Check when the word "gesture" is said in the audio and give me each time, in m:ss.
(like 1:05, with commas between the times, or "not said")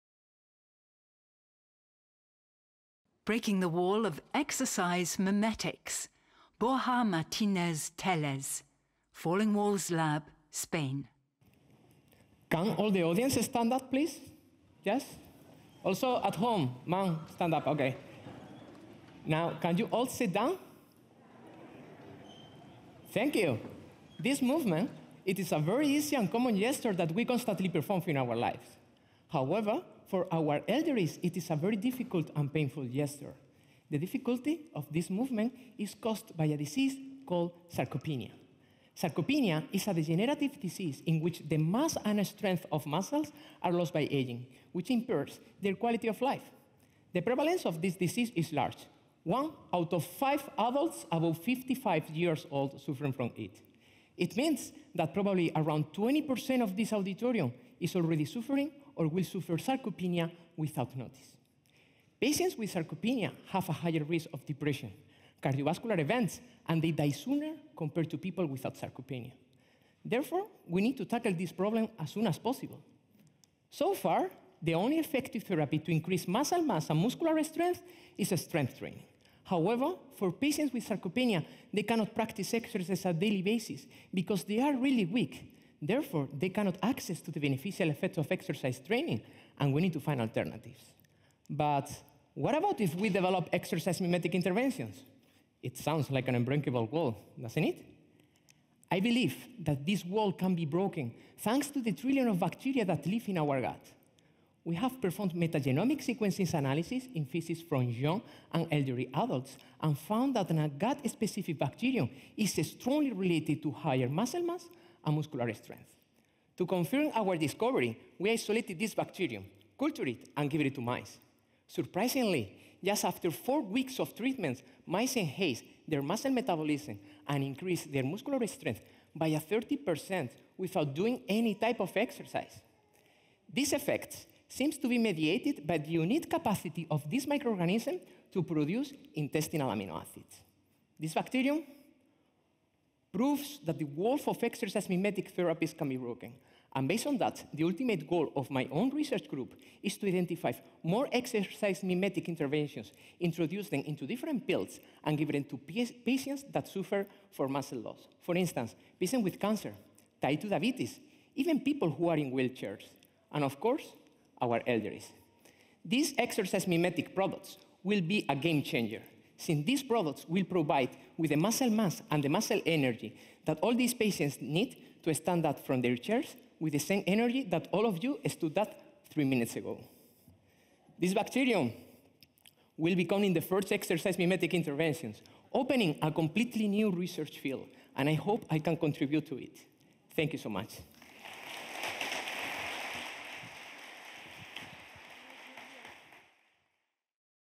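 0:26, 0:32.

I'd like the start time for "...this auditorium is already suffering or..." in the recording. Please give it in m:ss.
0:56.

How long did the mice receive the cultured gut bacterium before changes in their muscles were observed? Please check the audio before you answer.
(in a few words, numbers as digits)
4 weeks.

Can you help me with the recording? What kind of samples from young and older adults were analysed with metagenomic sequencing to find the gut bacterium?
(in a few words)
Feces.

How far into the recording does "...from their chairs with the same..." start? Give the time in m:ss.
2:55.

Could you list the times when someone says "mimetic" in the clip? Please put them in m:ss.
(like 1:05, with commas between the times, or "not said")
0:05, 1:33, 2:24, 2:31, 2:46, 3:04.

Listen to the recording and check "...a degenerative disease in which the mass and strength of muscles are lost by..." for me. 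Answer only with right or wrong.
right.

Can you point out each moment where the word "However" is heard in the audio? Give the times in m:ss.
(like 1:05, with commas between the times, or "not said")
0:29, 1:19.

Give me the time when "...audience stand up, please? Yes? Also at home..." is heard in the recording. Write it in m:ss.
0:13.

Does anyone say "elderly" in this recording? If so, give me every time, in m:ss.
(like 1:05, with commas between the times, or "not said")
0:30, 1:48, 2:44.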